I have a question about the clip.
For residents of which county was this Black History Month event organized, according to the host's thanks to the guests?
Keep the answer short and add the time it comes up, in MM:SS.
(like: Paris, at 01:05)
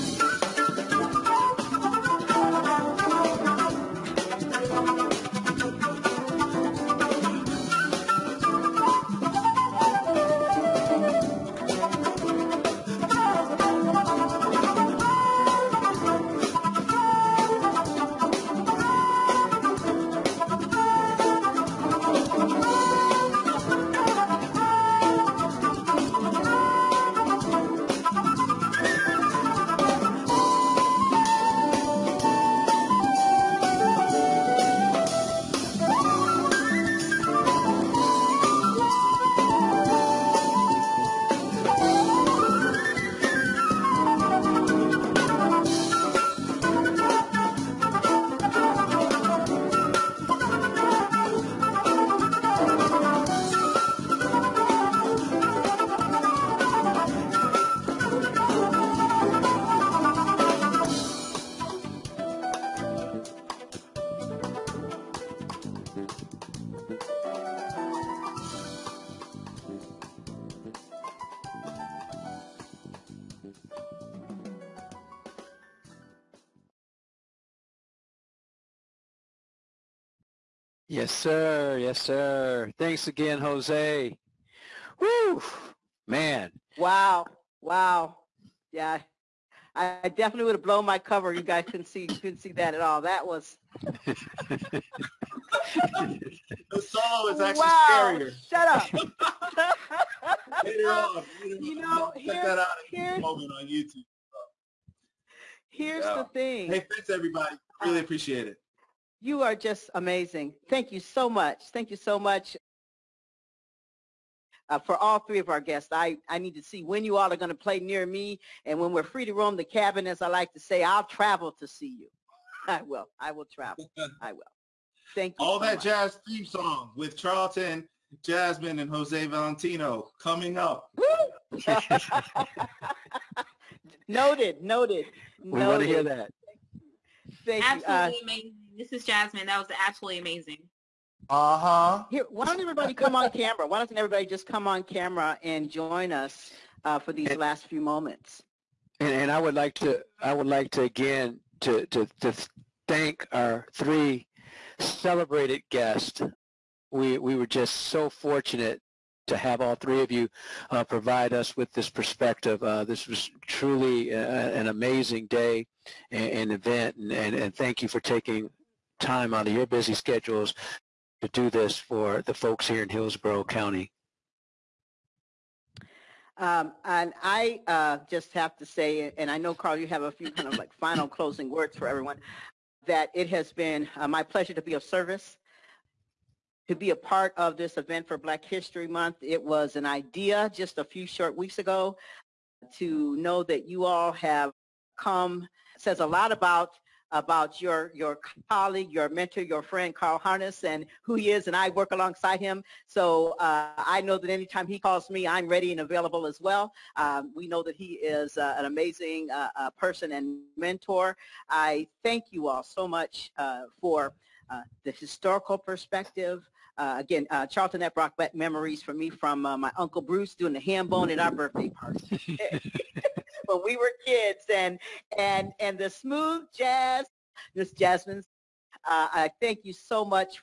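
Hillsborough County, at 02:52.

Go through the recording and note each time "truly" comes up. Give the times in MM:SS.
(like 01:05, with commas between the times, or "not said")
02:43.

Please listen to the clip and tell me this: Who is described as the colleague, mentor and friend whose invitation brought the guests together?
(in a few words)
Carl Harness.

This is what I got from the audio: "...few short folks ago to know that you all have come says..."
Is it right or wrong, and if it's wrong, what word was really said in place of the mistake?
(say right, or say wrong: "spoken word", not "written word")
wrong: "weeks", not "folks".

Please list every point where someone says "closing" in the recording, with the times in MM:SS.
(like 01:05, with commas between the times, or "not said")
03:01.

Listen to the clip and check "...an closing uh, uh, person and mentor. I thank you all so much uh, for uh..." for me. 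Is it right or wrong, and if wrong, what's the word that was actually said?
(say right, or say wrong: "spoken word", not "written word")
wrong: "amazing", not "closing".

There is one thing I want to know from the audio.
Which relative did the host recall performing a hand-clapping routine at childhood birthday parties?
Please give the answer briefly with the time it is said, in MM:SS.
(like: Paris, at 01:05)
Uncle Bruce, at 03:39.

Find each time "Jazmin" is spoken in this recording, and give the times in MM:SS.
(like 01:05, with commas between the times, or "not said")
02:08, 02:19, 03:47.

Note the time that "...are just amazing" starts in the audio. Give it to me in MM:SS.
01:49.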